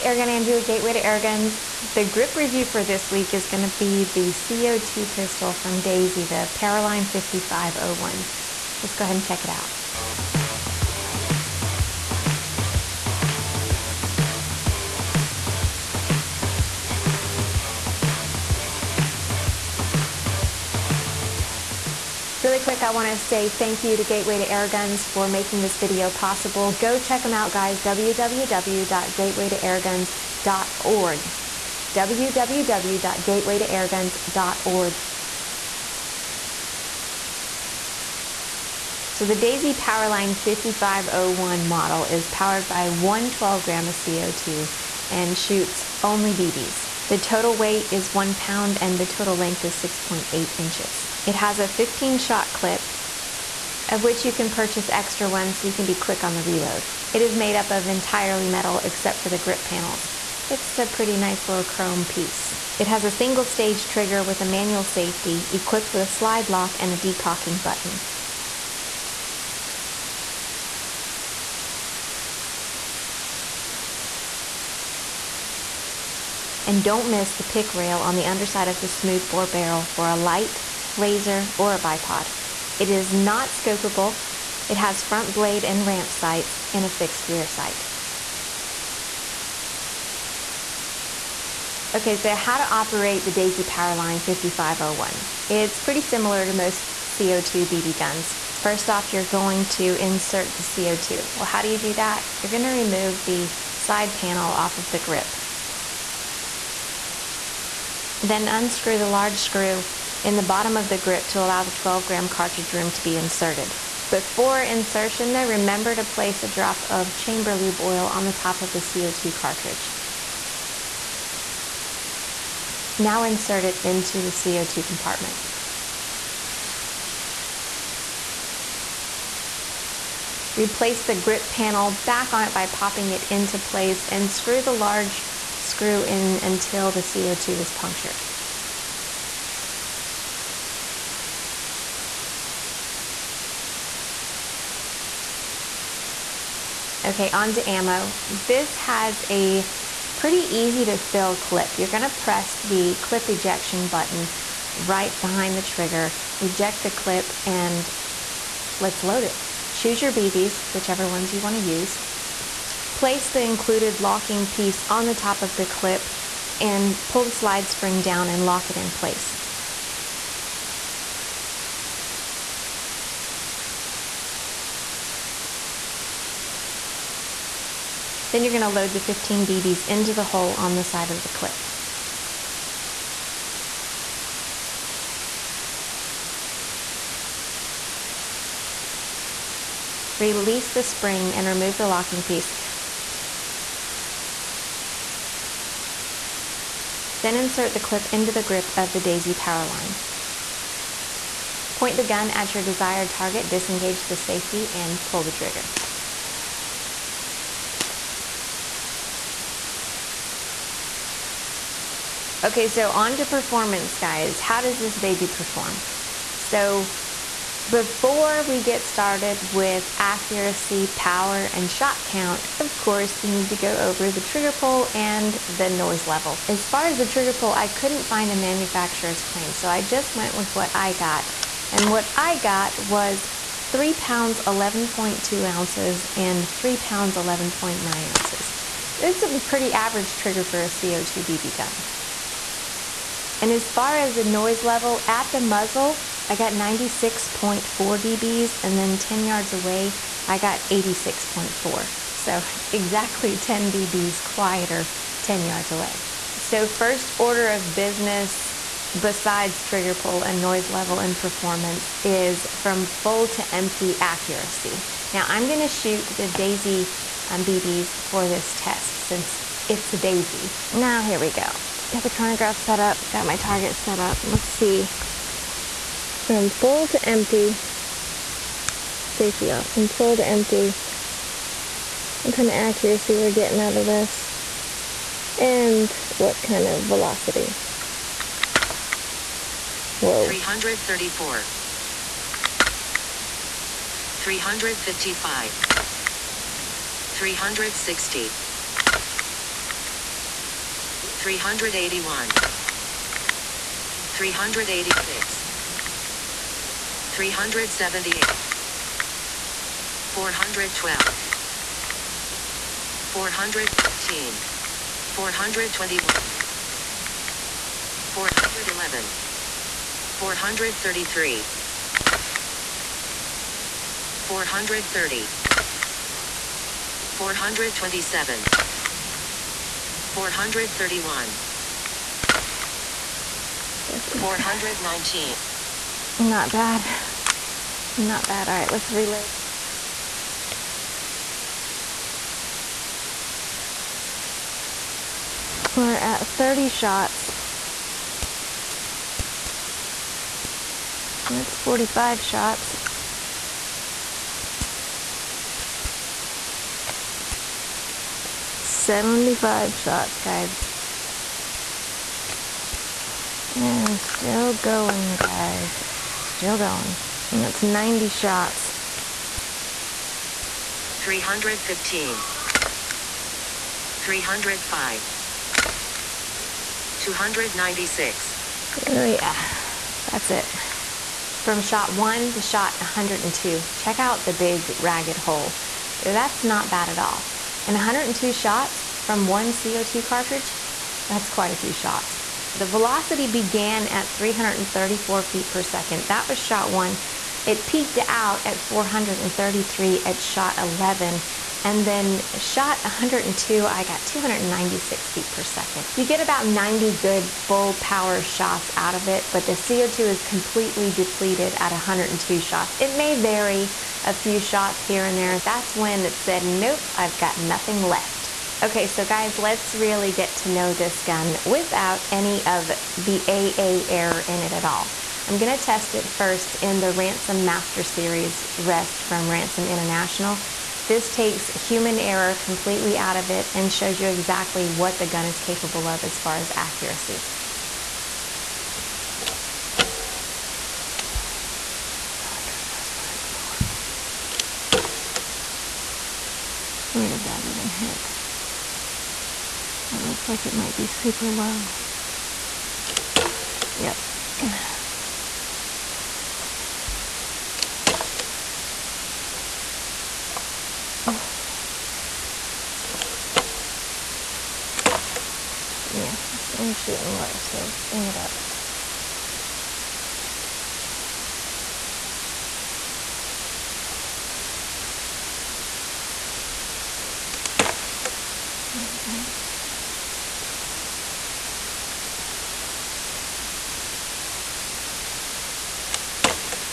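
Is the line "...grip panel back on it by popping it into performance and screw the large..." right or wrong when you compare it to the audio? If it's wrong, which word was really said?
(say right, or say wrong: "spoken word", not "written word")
wrong: "place", not "performance".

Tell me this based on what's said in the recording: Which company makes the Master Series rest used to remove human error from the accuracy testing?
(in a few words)
Ransom International.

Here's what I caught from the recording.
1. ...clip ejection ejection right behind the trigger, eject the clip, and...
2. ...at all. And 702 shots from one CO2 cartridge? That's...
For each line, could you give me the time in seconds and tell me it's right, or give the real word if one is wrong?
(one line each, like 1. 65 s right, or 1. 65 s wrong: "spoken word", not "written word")
1. 153 s wrong: "button", not "ejection"
2. 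386 s wrong: "102", not "702".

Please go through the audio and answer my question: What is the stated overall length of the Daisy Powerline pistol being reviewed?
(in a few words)
6.8 inches.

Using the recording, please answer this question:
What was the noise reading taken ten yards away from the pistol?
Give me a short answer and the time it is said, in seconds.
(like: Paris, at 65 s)
86.4 dB, at 250 s.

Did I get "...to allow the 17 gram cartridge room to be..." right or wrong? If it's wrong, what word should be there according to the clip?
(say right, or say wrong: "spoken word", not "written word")
wrong: "12", not "17".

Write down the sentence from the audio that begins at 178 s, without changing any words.
Then you're going to load the 15 BBs into the hole on the side of the clip.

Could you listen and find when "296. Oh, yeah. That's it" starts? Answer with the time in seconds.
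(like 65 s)
376 s.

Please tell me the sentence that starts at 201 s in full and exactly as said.
Point the gun at your desired target, disengage the safety, and pull the trigger.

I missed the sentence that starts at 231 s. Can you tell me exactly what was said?
And what I got was 3 pounds 11.2 ounces and 3 pounds 11.9 ounces.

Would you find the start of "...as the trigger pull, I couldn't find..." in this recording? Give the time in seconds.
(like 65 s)
226 s.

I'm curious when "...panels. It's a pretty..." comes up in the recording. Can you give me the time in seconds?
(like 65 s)
59 s.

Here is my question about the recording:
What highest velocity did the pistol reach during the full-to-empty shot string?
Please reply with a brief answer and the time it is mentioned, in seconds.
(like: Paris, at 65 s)
433 feet per second, at 398 s.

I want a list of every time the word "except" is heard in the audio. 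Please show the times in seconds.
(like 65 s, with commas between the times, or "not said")
58 s.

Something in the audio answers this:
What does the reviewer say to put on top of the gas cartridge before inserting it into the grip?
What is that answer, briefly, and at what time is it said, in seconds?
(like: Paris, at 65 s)
A drop of chamber lube oil, at 117 s.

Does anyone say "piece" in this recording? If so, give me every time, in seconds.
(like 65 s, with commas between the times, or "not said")
62 s, 164 s, 192 s.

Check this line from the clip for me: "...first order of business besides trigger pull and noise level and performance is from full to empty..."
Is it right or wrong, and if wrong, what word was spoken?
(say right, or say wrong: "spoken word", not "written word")
right.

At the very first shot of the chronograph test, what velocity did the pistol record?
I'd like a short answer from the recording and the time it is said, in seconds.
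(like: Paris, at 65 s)
334 feet per second, at 394 s.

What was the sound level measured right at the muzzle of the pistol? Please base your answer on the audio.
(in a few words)
96.4 dB.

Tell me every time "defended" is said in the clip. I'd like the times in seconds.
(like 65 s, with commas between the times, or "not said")
not said.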